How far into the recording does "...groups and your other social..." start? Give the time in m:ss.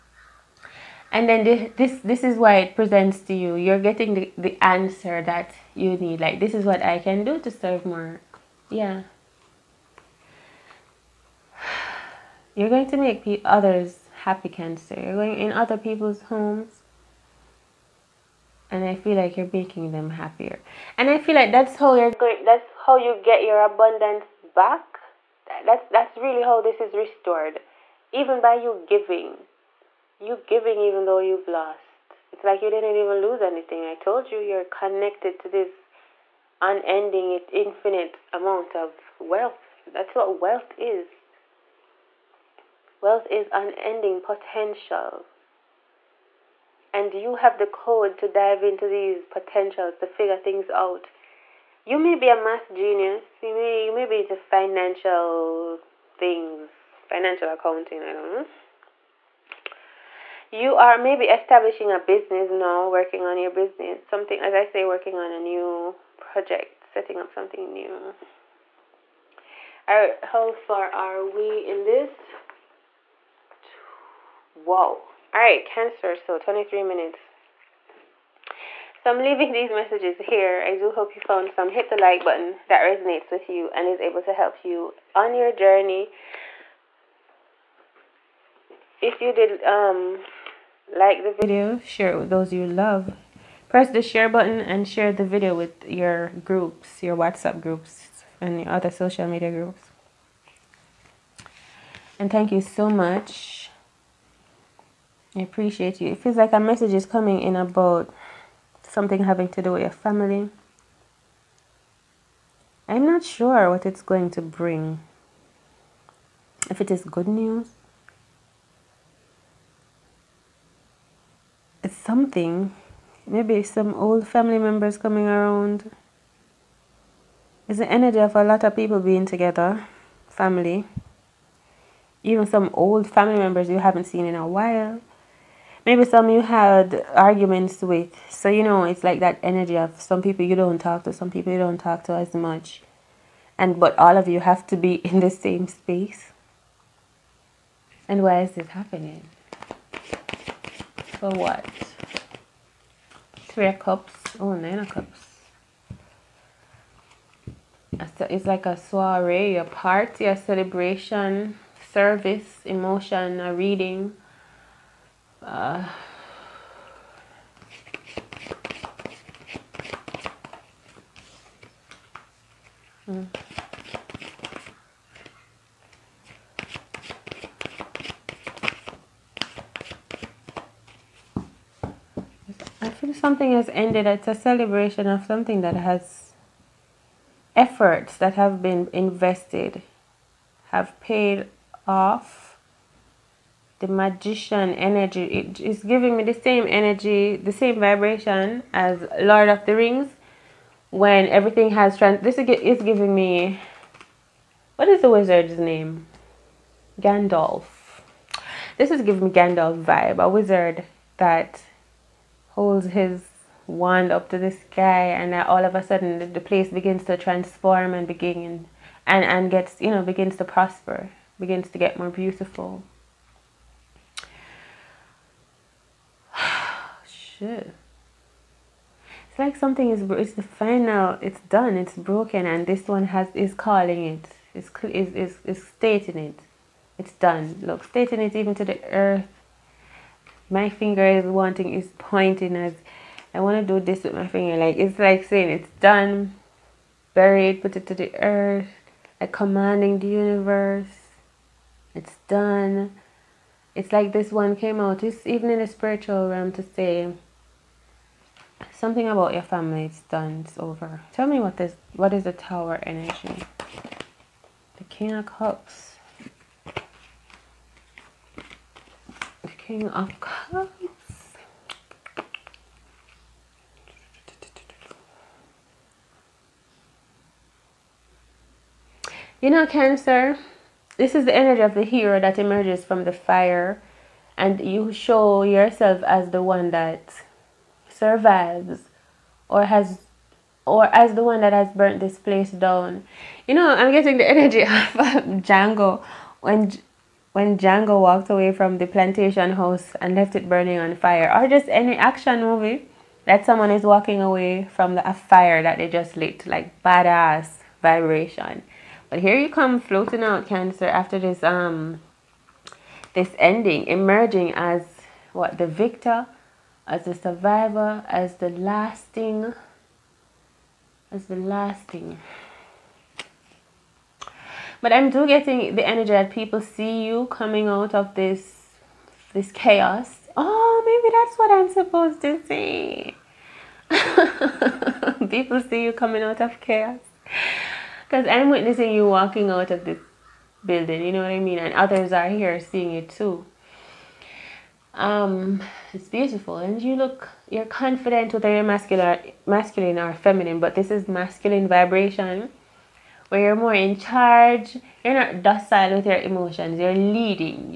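1:37.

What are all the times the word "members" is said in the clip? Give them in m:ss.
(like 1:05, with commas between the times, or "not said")
2:04, 2:13.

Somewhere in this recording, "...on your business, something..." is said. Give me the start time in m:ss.
1:03.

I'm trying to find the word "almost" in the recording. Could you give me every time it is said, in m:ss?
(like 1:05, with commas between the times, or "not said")
not said.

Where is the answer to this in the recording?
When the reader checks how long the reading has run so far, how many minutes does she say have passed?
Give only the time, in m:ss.
1:16.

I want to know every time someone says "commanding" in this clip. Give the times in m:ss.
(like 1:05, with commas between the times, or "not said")
4:09.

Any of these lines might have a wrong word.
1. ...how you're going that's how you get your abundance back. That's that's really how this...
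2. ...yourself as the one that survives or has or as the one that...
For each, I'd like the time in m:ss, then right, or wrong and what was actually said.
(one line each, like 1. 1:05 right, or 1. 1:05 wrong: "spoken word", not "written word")
1. 0:21 right
2. 4:45 right.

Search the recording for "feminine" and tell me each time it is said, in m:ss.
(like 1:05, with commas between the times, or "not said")
5:50.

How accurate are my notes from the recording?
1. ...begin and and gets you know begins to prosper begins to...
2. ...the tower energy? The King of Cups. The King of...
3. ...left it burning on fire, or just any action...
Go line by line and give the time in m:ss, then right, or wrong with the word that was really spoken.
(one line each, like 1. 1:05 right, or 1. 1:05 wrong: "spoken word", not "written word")
1. 3:38 right
2. 4:22 right
3. 5:00 right.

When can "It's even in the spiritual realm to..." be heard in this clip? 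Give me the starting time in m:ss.
4:15.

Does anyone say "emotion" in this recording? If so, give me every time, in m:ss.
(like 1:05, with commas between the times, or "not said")
2:42, 5:56.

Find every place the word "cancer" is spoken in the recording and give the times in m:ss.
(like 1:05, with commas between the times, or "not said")
0:14, 1:15, 4:39, 5:10.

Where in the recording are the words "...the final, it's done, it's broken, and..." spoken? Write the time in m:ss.
3:50.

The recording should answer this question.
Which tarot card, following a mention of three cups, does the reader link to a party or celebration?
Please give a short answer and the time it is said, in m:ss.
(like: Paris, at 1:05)
Nine of Cups, at 2:34.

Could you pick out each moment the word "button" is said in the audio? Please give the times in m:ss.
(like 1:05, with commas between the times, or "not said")
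1:22, 1:34.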